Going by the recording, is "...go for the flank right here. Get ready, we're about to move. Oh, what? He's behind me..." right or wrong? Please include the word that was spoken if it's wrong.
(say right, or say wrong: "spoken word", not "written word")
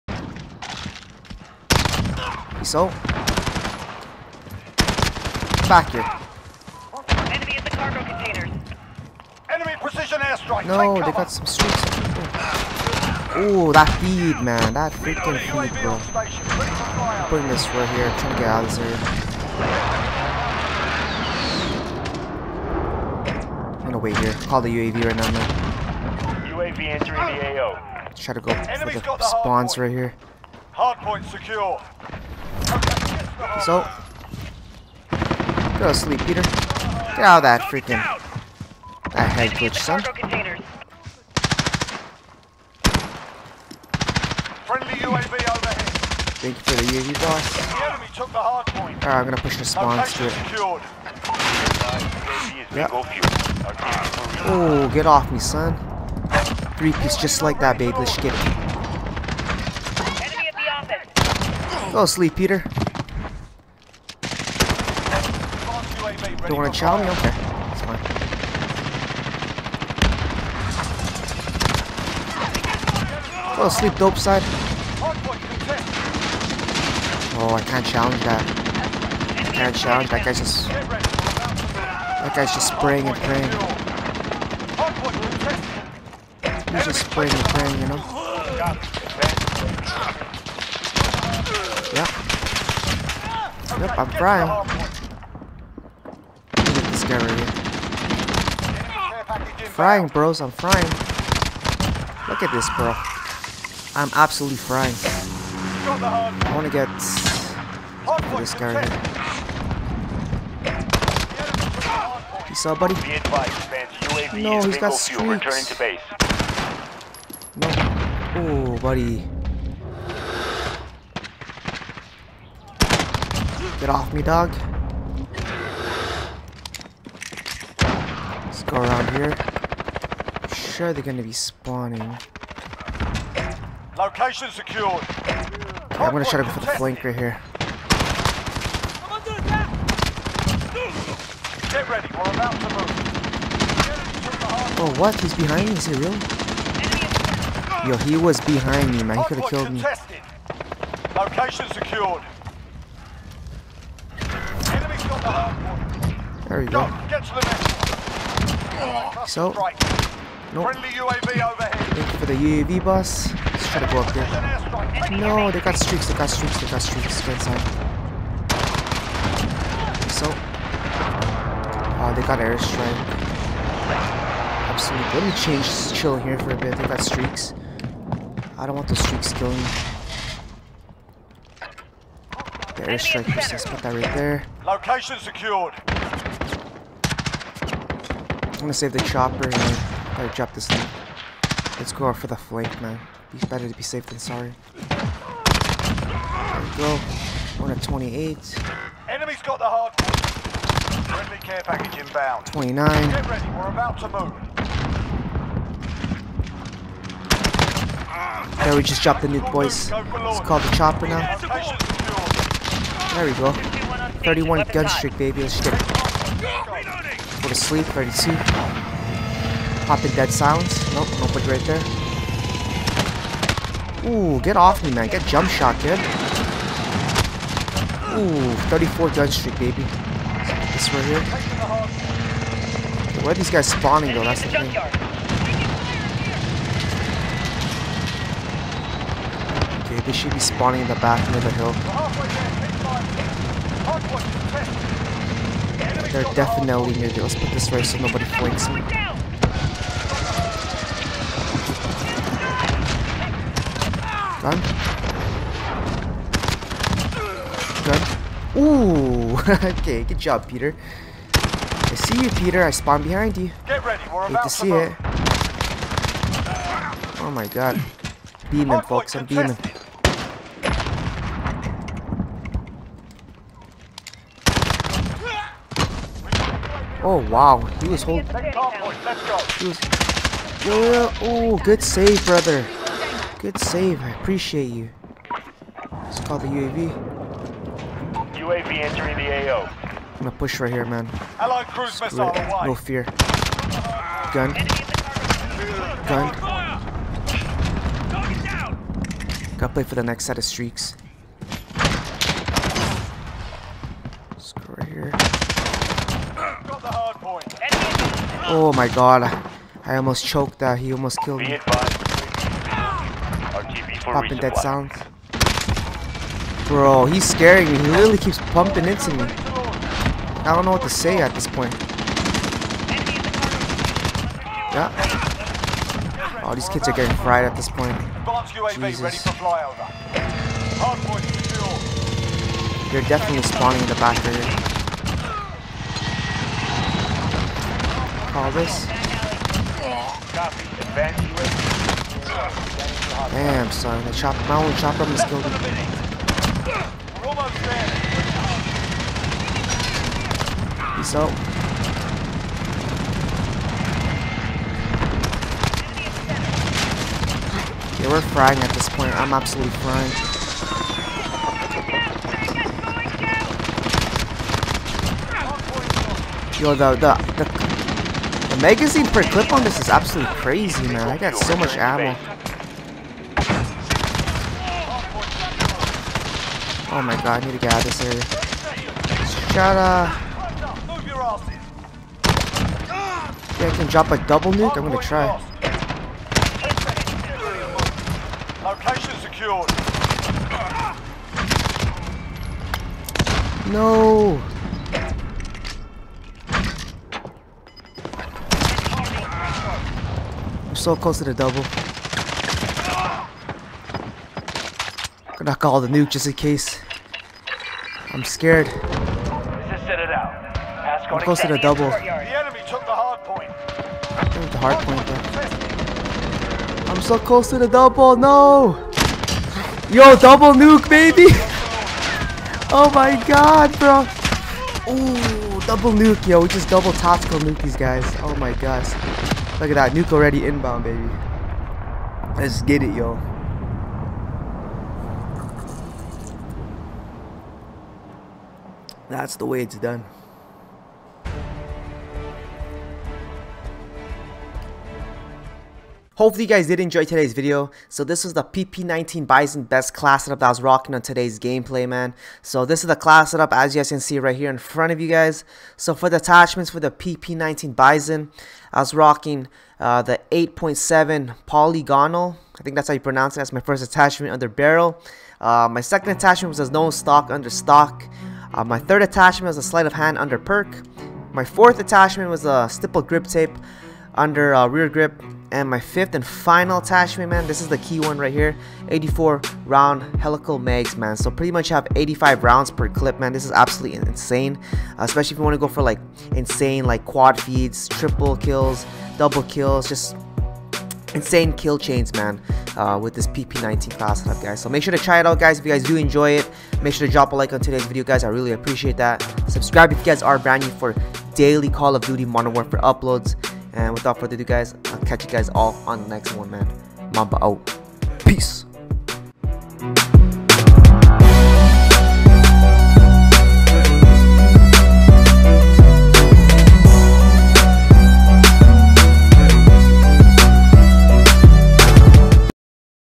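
right.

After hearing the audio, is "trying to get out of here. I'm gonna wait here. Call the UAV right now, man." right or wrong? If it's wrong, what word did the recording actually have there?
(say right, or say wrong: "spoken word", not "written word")
right.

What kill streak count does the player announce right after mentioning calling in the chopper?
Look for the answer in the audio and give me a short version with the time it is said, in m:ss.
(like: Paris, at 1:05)
31, at 3:34.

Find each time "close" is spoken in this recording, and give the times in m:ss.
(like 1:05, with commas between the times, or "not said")
6:40, 6:51, 6:57.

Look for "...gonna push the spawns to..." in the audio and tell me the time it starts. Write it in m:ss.
0:49.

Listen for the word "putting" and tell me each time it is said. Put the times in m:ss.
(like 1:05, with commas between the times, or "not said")
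0:17.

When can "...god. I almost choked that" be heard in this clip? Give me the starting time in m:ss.
5:08.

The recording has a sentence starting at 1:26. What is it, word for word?
He's just spraying and praying, you know?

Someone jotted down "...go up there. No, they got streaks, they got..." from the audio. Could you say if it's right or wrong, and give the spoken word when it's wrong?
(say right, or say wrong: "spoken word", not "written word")
right.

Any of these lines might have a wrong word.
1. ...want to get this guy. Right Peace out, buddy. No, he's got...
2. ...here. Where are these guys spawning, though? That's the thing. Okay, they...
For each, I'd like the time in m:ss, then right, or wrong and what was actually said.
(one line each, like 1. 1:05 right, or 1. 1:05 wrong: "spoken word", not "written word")
1. 1:46 right
2. 3:51 right.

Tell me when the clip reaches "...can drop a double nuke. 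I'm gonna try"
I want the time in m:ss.
6:23.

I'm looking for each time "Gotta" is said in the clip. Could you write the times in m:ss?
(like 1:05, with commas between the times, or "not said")
4:59.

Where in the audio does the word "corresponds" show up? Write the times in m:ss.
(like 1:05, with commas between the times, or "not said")
not said.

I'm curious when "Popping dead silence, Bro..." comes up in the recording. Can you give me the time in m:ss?
5:14.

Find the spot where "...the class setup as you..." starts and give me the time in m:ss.
7:32.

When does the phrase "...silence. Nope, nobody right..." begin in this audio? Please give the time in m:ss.
3:40.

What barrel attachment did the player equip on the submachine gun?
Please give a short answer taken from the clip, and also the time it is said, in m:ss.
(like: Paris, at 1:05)
8.7 polygonal, at 7:40.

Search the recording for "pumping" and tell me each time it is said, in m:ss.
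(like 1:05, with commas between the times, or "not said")
5:18.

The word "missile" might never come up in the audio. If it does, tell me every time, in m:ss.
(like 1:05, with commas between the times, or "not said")
4:52.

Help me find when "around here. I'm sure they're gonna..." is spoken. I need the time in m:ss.
2:08.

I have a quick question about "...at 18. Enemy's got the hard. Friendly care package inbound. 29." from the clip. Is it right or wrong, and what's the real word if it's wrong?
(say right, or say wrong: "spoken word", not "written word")
wrong: "28", not "18".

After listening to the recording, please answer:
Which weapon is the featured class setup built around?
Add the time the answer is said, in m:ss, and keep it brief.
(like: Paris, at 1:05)
PP19 Bizon, at 7:28.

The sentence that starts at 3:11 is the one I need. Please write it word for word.
Let's go out for the flank, man.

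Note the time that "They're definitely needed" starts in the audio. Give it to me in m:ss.
4:06.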